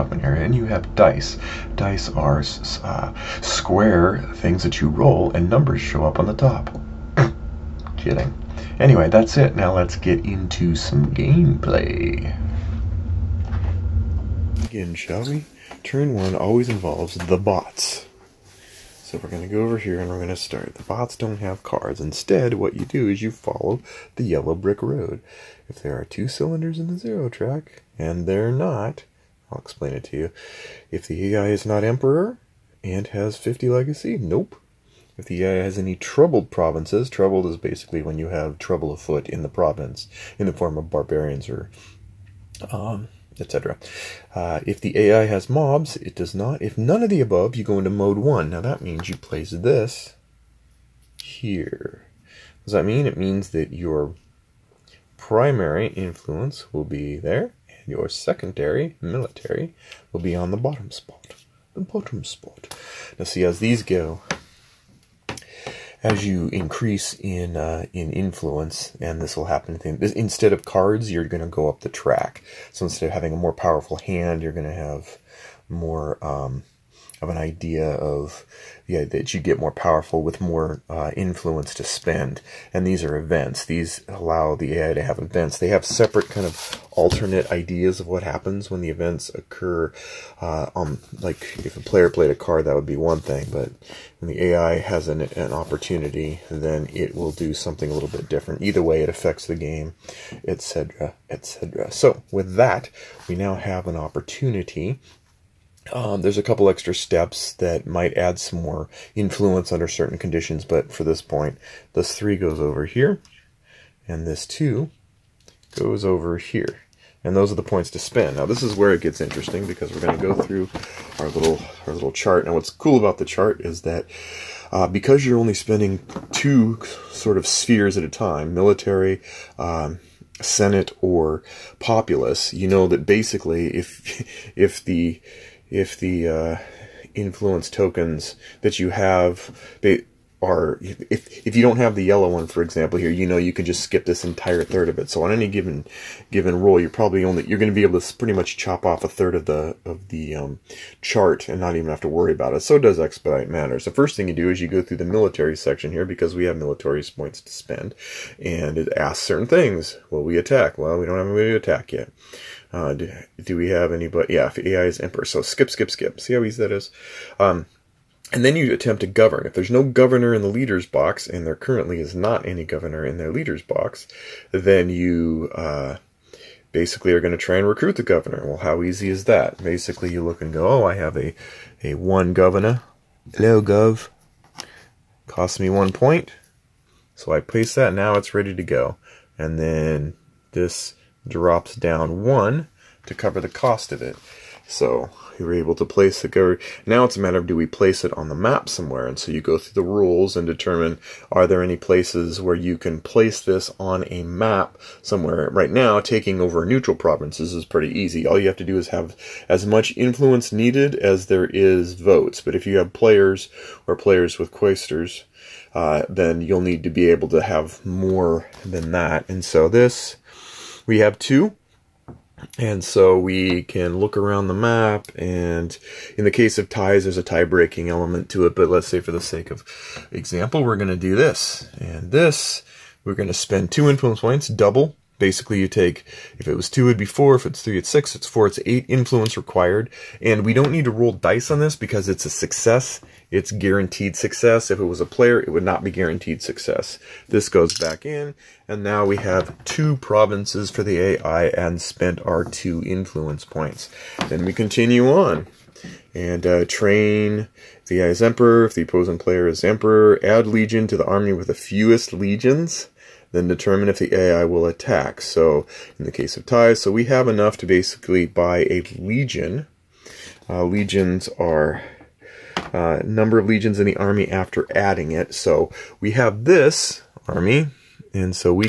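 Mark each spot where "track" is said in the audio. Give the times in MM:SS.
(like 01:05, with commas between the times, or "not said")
00:27, 01:11.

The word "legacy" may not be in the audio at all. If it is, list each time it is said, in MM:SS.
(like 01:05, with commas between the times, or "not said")
00:33.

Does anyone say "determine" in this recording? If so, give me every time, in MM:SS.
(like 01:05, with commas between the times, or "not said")
03:20, 04:23.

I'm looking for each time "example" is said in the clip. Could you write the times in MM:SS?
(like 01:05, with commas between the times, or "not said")
02:22, 03:50.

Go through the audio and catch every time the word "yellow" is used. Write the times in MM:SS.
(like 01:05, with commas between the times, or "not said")
00:24, 02:22.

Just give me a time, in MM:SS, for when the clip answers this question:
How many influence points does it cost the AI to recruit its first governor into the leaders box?
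03:05.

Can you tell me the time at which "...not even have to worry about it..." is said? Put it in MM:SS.
02:31.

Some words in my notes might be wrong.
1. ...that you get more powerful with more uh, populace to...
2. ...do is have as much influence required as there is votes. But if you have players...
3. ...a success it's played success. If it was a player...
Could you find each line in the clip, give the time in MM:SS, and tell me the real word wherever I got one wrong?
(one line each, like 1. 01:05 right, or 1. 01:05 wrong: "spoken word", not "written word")
1. 01:19 wrong: "influence", not "populace"
2. 03:28 wrong: "needed", not "required"
3. 04:02 wrong: "guaranteed", not "played".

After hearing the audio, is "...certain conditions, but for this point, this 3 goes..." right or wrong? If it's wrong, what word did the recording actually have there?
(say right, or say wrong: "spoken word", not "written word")
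right.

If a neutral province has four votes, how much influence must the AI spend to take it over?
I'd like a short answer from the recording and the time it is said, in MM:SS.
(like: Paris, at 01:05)
8, at 03:58.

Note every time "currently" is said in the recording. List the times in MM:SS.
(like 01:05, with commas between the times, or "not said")
02:51.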